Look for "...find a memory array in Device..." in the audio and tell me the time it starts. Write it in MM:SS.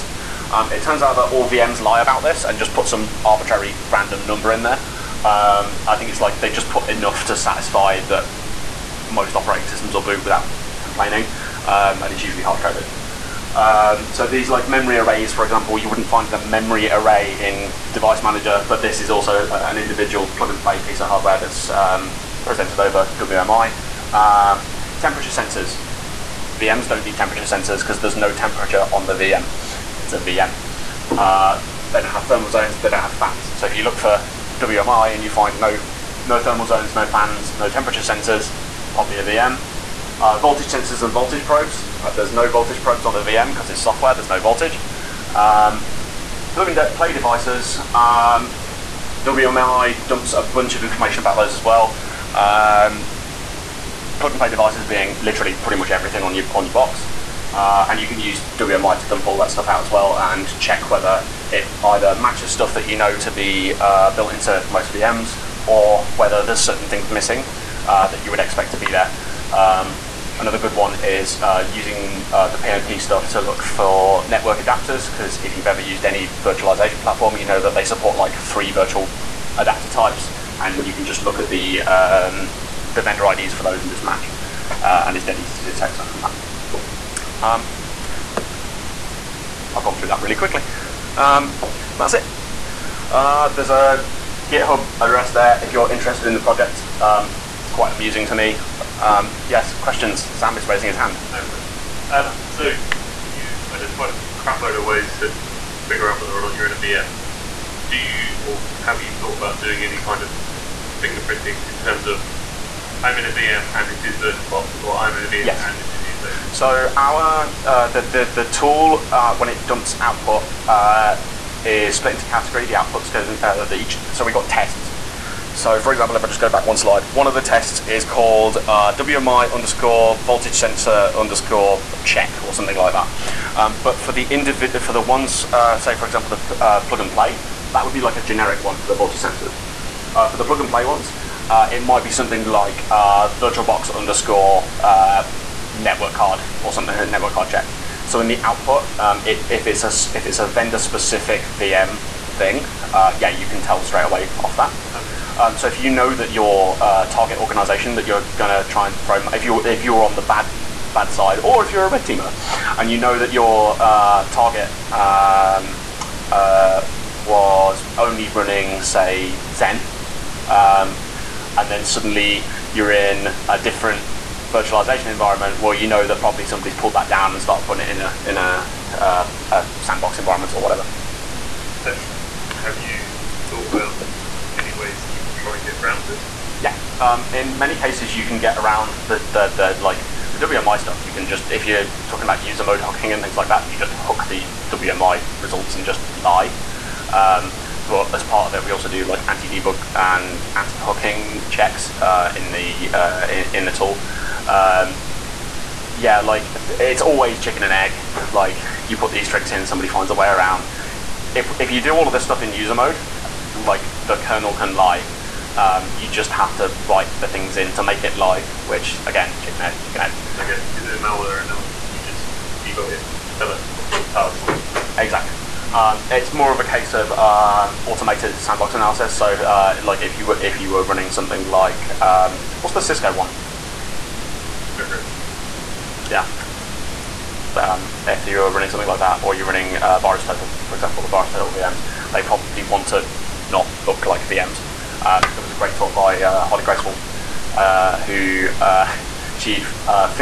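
00:16.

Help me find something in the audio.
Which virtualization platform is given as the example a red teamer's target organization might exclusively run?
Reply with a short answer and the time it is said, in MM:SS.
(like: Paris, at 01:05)
Xen, at 02:49.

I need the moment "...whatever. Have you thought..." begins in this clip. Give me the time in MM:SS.
03:00.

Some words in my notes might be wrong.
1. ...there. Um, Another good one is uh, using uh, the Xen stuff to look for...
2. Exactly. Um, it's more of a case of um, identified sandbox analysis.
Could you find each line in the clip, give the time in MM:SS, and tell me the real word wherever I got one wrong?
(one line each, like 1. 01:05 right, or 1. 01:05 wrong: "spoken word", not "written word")
1. 01:08 wrong: "PNP", not "Xen"
2. 03:45 wrong: "automated", not "identified".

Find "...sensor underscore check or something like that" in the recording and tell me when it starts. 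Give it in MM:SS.
02:10.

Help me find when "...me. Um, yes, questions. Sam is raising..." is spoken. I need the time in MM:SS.
01:38.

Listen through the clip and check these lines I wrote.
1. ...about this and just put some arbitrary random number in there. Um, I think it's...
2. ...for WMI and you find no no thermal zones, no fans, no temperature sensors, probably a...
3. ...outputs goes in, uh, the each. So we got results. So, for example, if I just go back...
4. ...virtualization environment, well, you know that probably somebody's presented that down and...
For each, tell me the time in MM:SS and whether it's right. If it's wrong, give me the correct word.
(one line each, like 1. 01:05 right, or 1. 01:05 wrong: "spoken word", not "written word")
1. 00:01 right
2. 00:33 right
3. 02:02 wrong: "tests", not "results"
4. 02:54 wrong: "pulled", not "presented".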